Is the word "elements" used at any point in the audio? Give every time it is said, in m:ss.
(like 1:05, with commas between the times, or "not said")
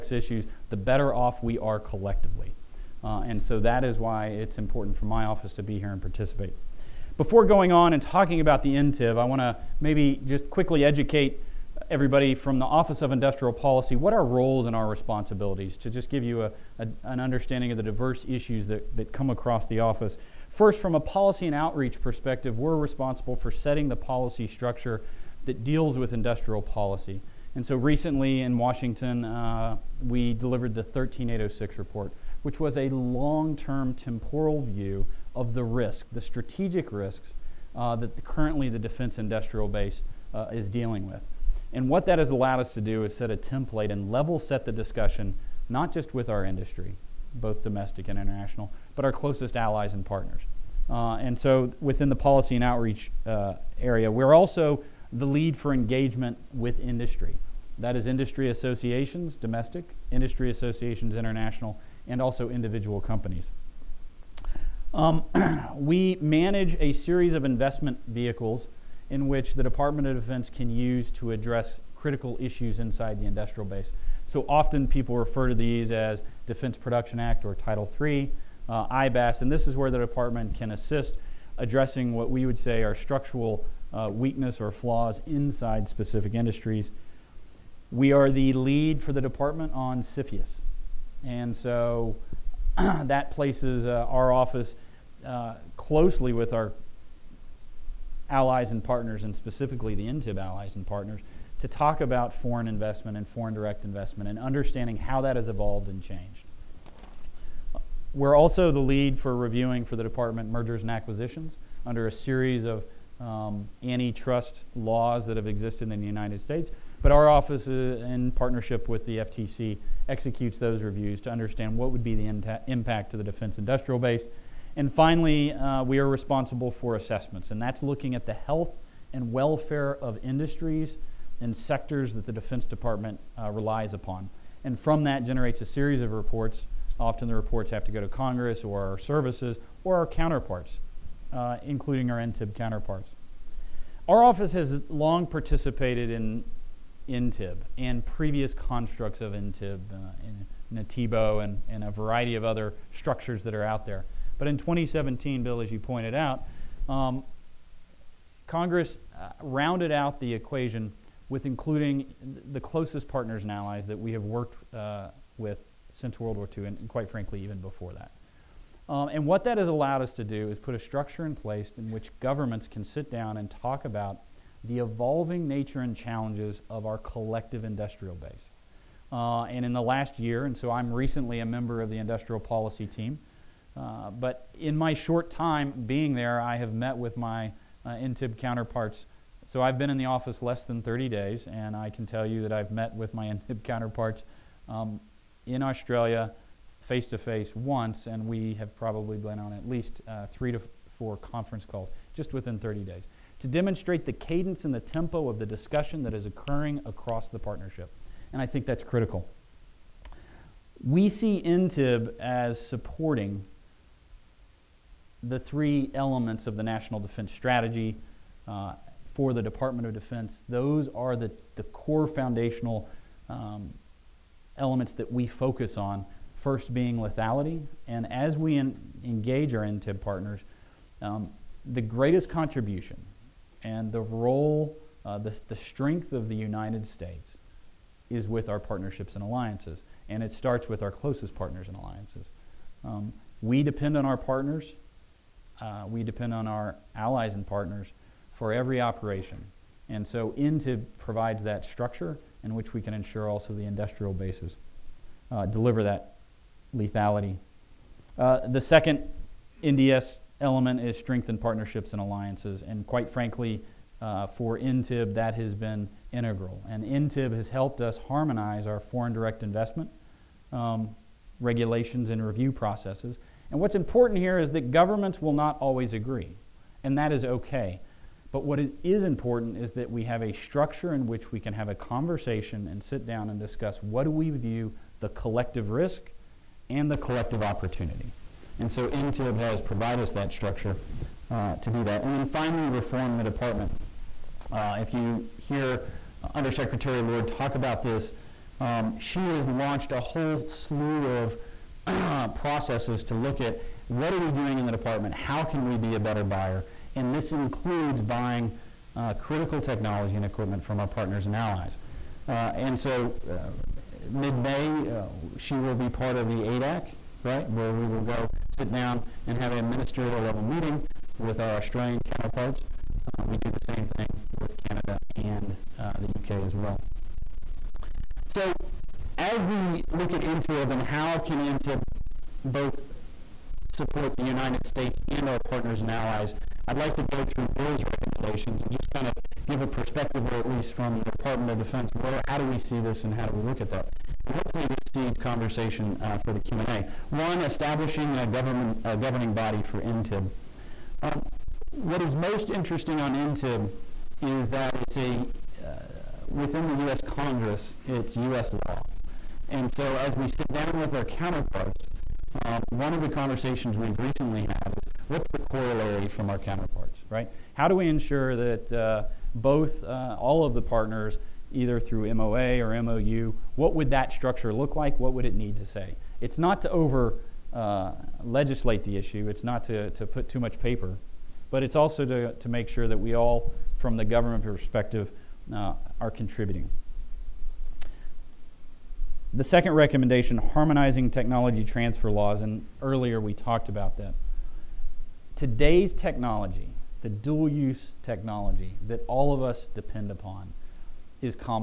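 3:35, 3:44, 4:20.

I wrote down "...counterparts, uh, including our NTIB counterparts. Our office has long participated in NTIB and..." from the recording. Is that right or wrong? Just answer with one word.
right.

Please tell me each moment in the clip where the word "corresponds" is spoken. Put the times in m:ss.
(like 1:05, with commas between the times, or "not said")
not said.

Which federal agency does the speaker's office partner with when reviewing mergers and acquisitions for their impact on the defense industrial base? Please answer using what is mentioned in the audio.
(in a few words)
FTC.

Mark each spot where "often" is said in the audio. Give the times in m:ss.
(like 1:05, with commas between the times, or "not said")
1:14, 2:17.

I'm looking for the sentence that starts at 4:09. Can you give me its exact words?
And so INTIB provides that structure in which we can ensure also the industrial bases, uh, deliver that lethality.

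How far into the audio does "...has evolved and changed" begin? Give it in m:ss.
1:45.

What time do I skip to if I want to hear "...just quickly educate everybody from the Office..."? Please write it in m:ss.
0:10.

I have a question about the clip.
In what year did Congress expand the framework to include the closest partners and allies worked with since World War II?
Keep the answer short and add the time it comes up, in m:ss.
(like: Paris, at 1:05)
2017, at 2:34.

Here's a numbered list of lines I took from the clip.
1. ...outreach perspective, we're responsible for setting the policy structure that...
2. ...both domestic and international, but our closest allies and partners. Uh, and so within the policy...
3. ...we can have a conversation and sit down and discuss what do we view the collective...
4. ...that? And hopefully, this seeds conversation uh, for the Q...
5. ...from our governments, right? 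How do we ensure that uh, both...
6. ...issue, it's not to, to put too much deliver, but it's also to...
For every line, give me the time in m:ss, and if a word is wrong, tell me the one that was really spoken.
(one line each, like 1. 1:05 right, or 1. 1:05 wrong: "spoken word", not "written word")
1. 0:21 right
2. 0:47 right
3. 4:41 right
4. 5:43 right
5. 6:06 wrong: "counterparts", not "governments"
6. 6:18 wrong: "paper", not "deliver".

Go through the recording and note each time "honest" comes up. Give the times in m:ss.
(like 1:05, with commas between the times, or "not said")
not said.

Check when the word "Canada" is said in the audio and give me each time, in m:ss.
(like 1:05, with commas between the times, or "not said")
5:24.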